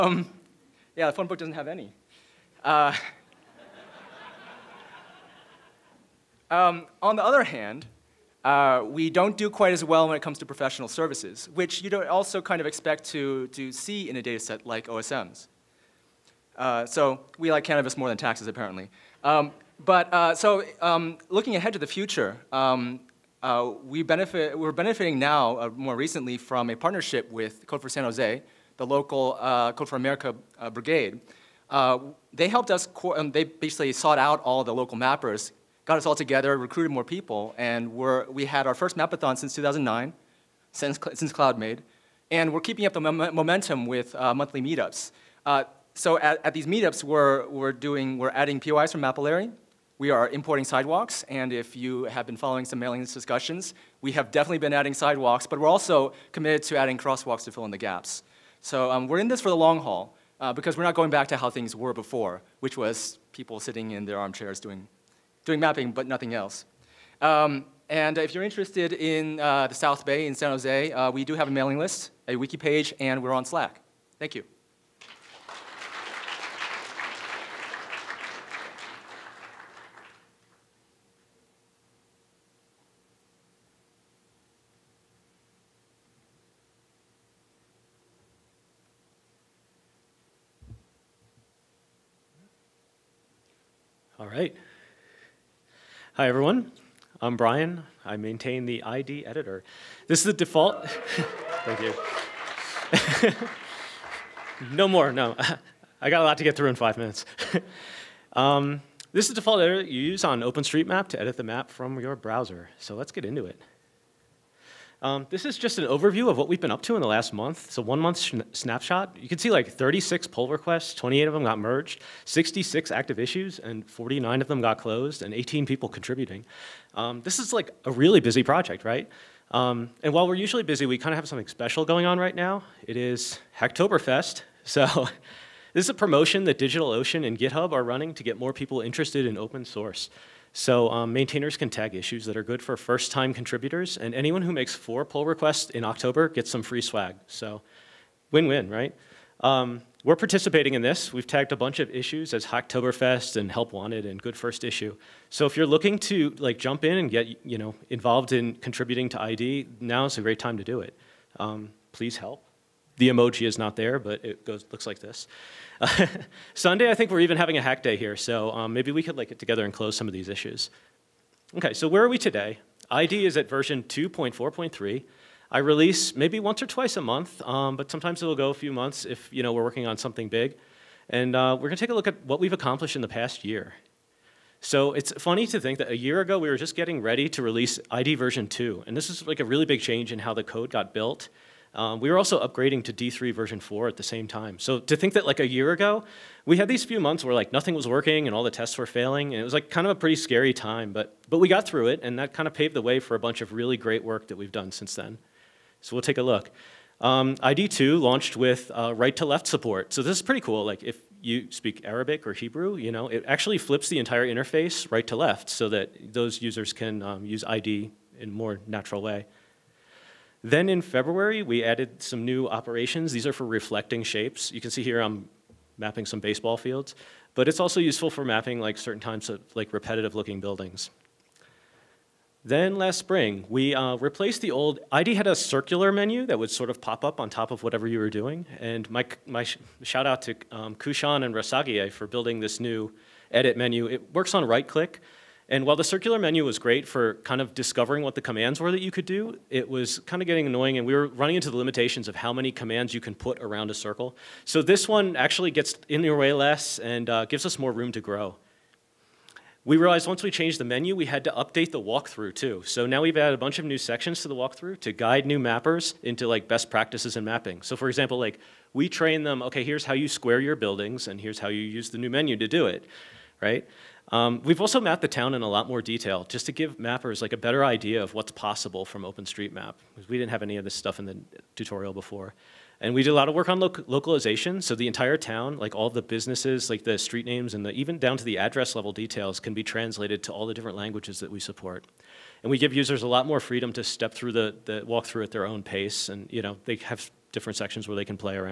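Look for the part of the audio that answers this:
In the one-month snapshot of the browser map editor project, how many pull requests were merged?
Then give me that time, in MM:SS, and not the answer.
02:00.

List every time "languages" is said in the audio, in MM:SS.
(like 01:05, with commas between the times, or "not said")
04:50.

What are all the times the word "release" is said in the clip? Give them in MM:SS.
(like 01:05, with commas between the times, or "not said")
02:55, 03:07.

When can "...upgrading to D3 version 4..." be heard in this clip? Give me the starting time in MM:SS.
03:12.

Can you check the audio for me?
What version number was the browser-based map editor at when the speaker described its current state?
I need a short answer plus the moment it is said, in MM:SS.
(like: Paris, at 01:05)
2.4.3, at 02:53.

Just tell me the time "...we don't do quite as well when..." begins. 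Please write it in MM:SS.
00:08.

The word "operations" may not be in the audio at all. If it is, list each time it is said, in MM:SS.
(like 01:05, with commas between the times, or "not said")
03:42.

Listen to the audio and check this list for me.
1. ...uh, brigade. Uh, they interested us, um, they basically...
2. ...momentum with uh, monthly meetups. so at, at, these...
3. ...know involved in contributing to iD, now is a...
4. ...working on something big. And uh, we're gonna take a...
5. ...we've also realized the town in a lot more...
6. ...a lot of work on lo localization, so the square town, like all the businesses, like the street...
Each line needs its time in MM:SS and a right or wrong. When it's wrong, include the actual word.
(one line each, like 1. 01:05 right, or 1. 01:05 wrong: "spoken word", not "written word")
1. 00:30 wrong: "helped", not "interested"
2. 00:42 right
3. 02:37 right
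4. 02:59 right
5. 04:34 wrong: "mapped", not "realized"
6. 04:43 wrong: "entire", not "square".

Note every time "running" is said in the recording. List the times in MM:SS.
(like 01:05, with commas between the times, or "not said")
02:17, 04:11.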